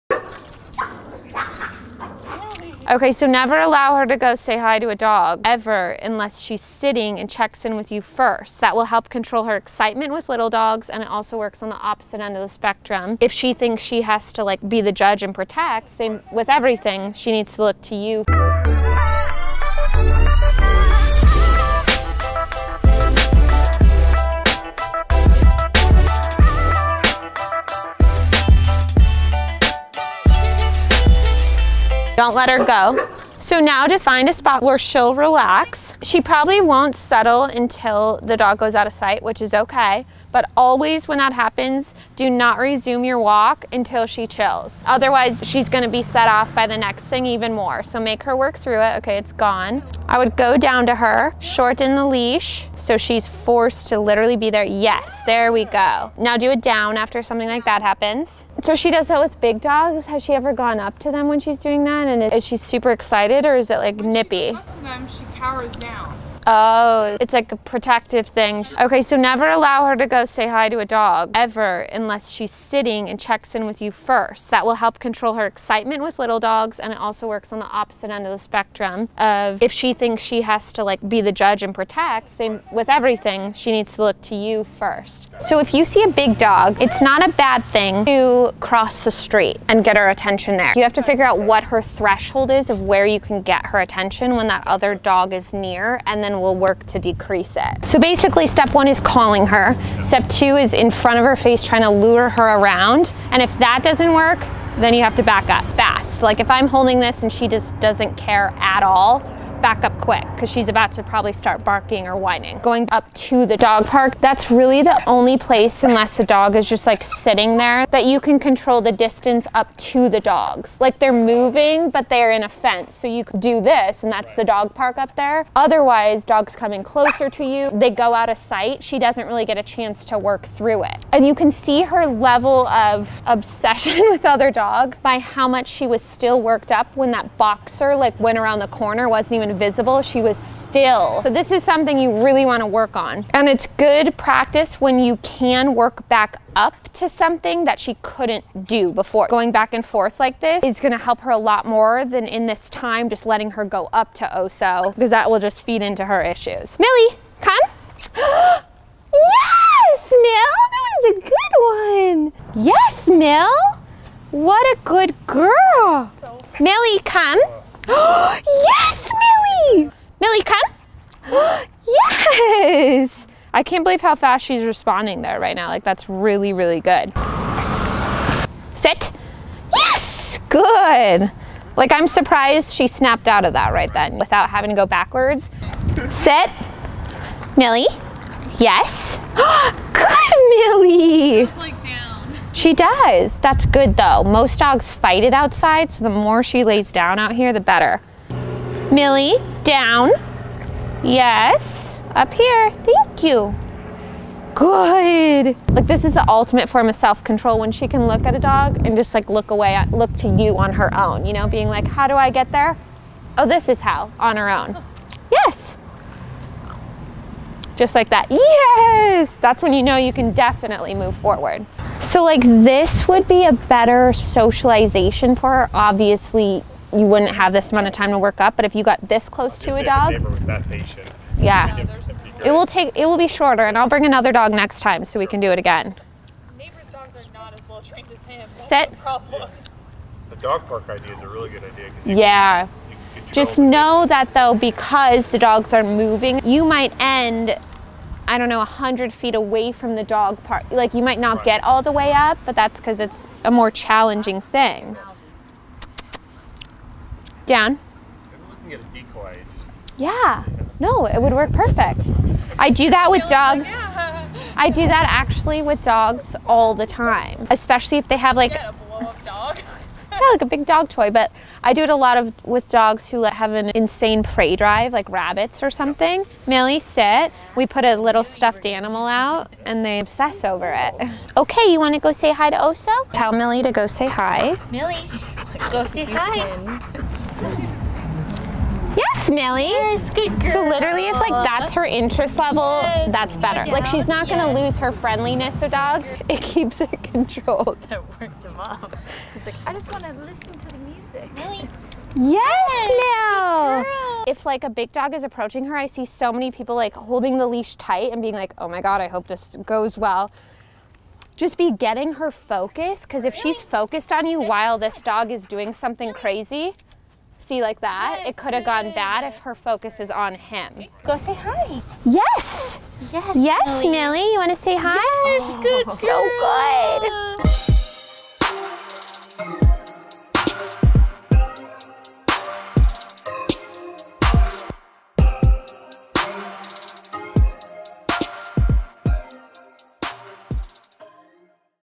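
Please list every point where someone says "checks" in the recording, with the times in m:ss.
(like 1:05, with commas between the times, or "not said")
0:07, 1:13.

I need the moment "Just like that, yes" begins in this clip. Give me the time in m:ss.
3:37.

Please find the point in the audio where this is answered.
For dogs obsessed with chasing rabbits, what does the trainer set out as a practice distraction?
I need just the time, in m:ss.
4:37.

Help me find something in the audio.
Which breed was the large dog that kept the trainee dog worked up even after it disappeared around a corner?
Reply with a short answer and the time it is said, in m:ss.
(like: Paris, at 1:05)
Boxer, at 2:17.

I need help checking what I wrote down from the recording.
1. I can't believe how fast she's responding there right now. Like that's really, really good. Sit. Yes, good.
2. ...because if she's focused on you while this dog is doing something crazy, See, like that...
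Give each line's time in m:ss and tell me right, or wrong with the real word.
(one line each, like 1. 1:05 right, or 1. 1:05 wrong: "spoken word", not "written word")
1. 2:53 right
2. 5:13 right.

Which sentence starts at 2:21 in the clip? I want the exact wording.
So this is something you really wanna work on.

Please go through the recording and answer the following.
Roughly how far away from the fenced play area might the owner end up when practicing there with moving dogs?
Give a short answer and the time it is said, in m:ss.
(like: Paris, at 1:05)
100 feet, at 4:08.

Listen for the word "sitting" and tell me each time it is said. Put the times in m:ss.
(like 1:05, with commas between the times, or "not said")
0:06, 1:12, 1:57.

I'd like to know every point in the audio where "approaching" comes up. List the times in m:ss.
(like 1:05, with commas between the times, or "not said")
5:05.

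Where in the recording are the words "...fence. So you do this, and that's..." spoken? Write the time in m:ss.
2:02.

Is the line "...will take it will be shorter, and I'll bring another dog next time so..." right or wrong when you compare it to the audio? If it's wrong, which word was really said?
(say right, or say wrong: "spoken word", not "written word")
right.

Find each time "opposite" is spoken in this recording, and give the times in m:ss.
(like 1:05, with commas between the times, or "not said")
0:11, 1:17.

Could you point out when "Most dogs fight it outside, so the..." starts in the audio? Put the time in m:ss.
3:14.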